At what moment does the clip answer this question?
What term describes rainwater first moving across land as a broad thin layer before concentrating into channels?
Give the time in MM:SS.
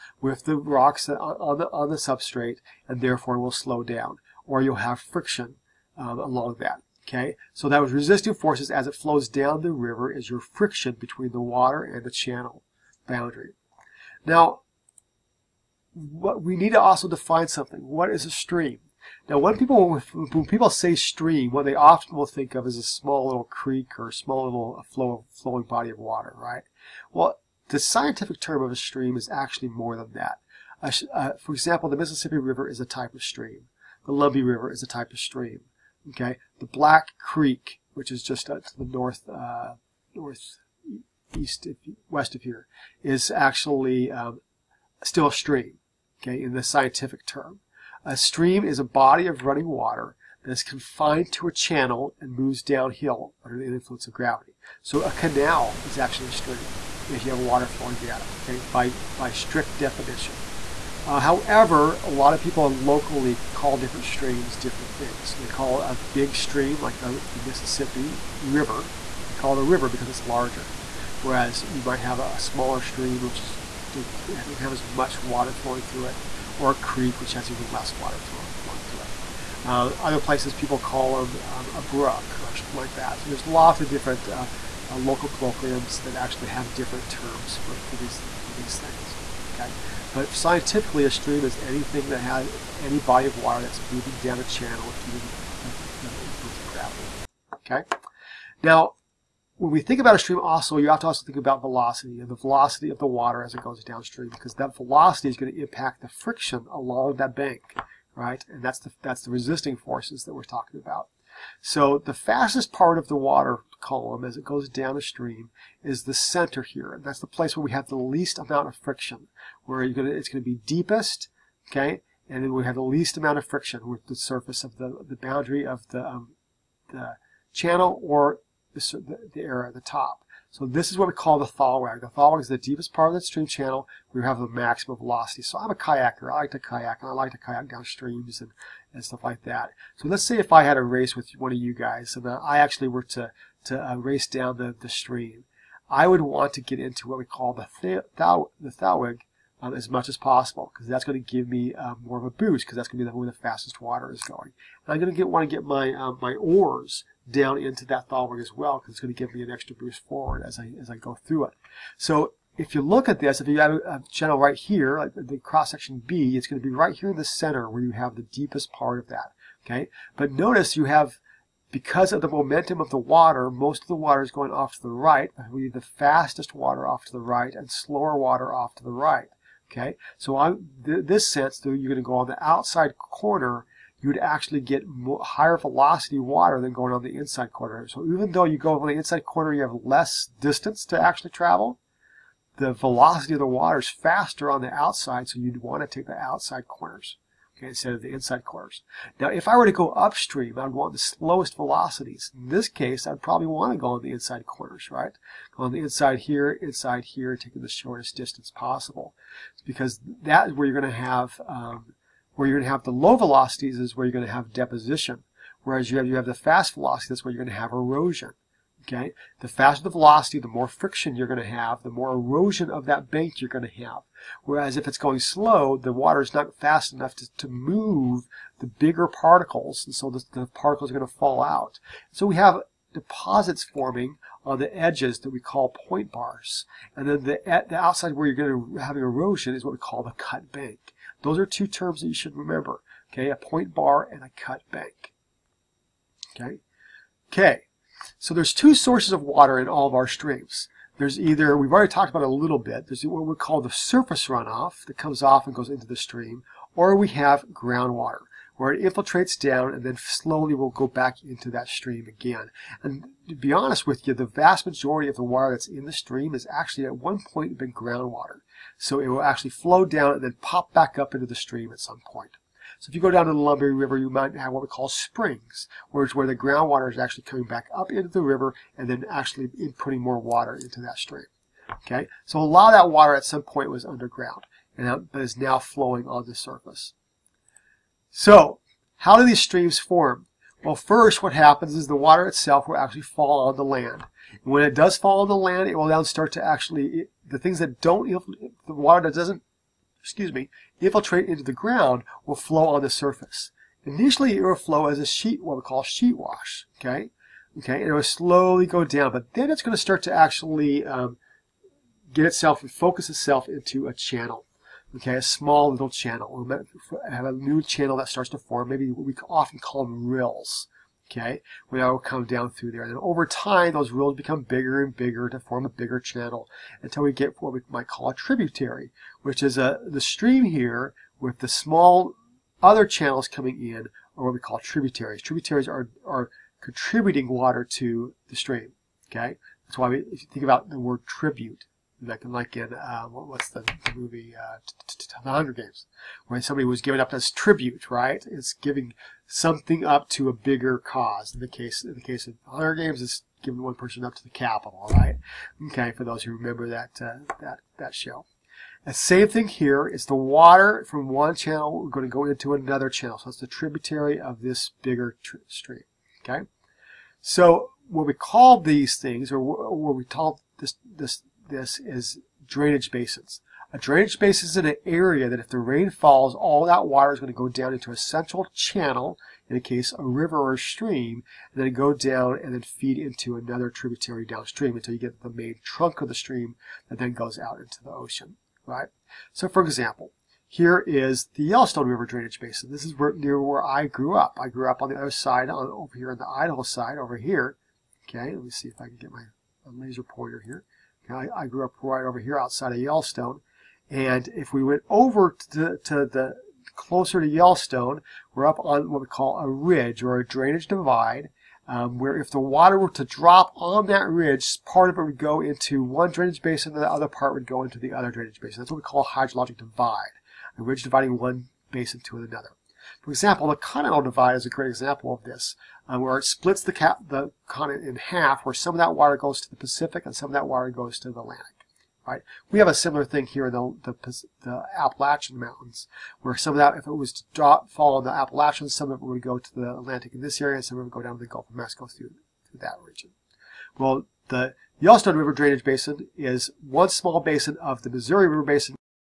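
05:05.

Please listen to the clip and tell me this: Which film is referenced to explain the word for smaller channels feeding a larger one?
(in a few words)
The Hunger Games.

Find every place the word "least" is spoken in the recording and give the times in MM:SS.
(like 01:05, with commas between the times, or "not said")
01:57, 02:02.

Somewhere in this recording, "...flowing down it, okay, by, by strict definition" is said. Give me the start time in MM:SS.
00:57.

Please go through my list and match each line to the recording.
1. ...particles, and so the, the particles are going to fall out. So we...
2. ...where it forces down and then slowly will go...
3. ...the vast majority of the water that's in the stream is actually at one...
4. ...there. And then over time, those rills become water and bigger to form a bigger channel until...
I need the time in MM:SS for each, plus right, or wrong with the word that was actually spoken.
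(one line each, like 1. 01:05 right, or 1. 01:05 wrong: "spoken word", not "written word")
1. 03:49 right
2. 04:18 wrong: "infiltrates", not "forces"
3. 04:24 right
4. 05:22 wrong: "bigger", not "water".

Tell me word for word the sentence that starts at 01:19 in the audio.
Uh, other places people call them um, a brook or something like that.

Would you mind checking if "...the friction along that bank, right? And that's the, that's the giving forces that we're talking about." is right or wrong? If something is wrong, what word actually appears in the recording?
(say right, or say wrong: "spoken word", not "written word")
wrong: "resisting", not "giving".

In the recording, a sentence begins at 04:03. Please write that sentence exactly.
Okay, a point bar and a cut bank.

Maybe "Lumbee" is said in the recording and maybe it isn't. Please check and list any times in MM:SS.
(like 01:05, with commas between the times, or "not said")
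00:34, 04:33.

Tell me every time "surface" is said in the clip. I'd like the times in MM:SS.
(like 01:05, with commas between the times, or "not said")
02:04, 04:13, 04:46, 05:02.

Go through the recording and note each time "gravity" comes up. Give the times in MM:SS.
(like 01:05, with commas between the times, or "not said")
00:54, 01:36.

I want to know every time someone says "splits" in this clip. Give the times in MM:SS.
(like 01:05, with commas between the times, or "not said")
07:06.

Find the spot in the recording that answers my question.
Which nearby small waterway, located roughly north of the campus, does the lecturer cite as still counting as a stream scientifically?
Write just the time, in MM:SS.
00:36.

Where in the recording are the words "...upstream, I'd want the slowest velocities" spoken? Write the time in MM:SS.
03:19.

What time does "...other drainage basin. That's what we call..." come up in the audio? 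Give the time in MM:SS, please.
06:57.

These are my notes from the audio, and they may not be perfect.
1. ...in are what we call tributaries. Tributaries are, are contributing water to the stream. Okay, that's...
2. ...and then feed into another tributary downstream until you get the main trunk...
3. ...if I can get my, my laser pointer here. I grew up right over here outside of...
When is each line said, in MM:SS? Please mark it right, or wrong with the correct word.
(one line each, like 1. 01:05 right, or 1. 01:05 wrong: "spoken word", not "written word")
1. 05:33 right
2. 06:22 right
3. 06:38 right.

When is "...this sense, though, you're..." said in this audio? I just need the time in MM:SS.
03:01.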